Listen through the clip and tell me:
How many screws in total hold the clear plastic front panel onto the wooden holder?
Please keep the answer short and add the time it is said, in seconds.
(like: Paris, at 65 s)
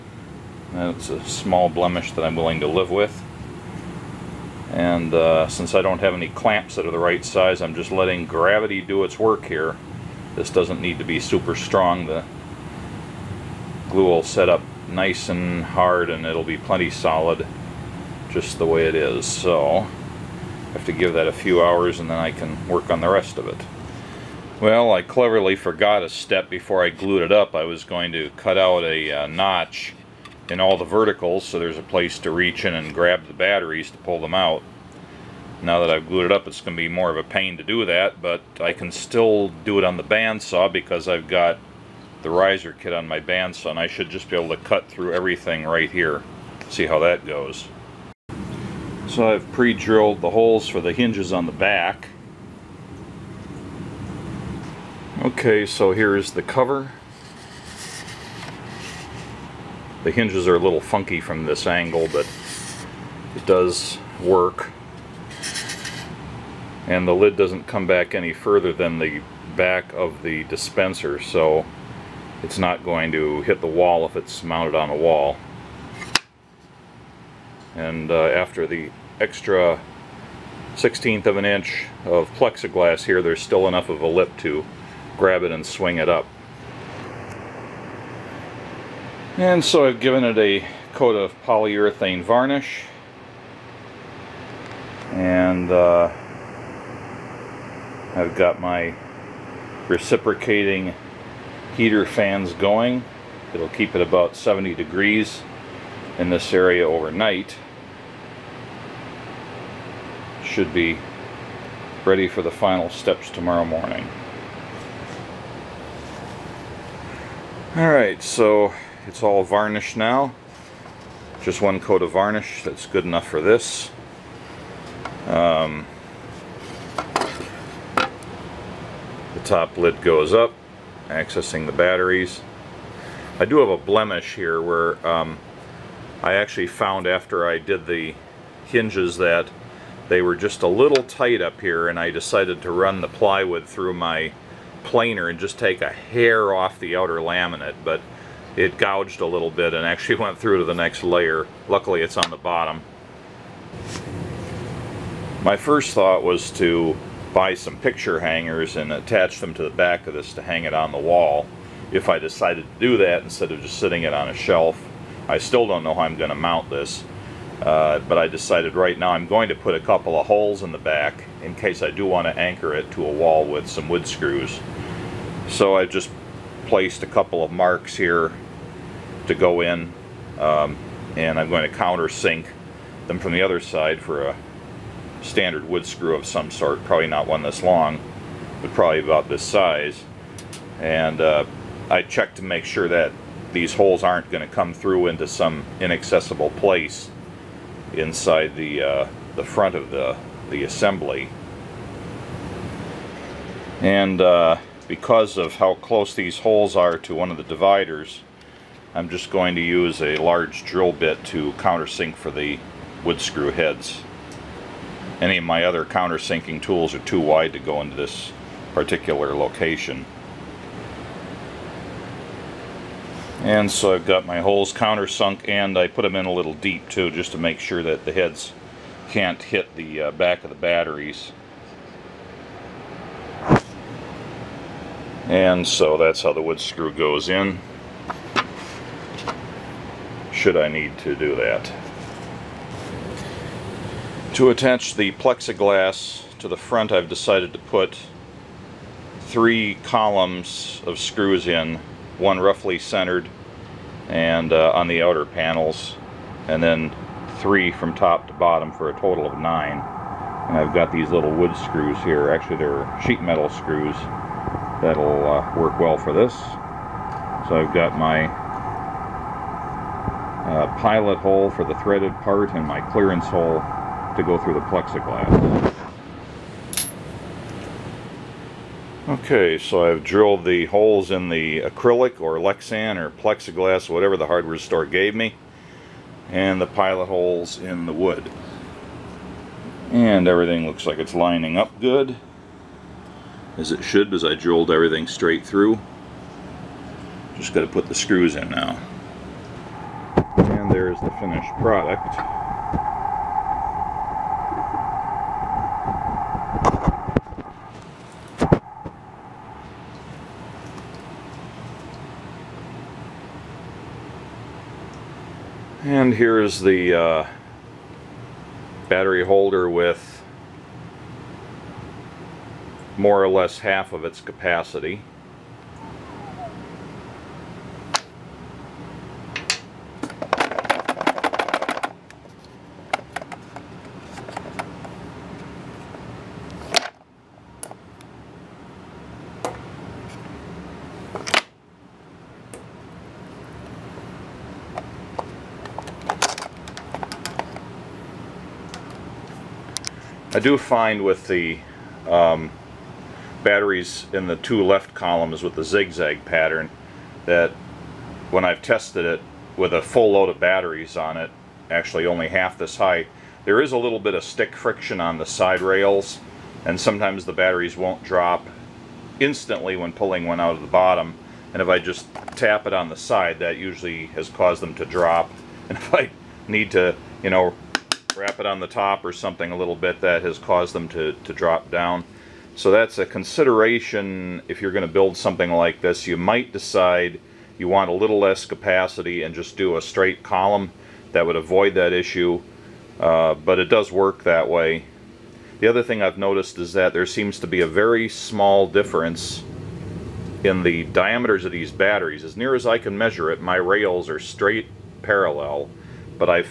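9, at 259 s.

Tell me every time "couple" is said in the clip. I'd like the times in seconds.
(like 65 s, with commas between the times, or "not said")
169 s, 177 s.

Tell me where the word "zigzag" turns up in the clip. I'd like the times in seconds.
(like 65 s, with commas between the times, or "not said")
355 s.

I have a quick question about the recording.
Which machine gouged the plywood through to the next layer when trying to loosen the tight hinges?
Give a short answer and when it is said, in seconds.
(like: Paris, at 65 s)
planer, at 144 s.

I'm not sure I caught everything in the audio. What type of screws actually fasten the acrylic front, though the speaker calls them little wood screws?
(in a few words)
sheet metal screws.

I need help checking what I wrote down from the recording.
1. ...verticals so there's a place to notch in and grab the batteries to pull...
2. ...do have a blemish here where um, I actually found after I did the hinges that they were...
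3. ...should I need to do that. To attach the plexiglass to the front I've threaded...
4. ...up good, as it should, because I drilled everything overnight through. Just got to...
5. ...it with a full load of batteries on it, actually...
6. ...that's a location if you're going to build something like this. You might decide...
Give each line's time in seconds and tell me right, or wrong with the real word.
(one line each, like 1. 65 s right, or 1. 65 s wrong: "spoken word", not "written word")
1. 30 s wrong: "reach", not "notch"
2. 133 s right
3. 240 s wrong: "decided", not "threaded"
4. 291 s wrong: "straight", not "overnight"
5. 359 s right
6. 382 s wrong: "consideration", not "location".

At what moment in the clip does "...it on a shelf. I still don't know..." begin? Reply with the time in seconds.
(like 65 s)
164 s.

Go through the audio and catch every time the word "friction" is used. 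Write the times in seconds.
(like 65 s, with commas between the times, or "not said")
364 s.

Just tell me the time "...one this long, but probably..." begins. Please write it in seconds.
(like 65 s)
187 s.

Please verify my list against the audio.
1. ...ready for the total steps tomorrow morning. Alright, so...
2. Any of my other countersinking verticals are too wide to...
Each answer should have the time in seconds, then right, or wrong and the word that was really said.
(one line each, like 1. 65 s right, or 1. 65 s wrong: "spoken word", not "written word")
1. 112 s wrong: "final", not "total"
2. 215 s wrong: "tools", not "verticals".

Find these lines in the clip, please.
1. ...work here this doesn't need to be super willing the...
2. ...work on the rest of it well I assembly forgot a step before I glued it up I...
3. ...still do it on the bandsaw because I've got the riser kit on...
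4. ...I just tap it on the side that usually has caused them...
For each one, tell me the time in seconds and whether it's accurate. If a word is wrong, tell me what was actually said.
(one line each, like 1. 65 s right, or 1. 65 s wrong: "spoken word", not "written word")
1. 9 s wrong: "strong", not "willing"
2. 22 s wrong: "cleverly", not "assembly"
3. 38 s right
4. 371 s right.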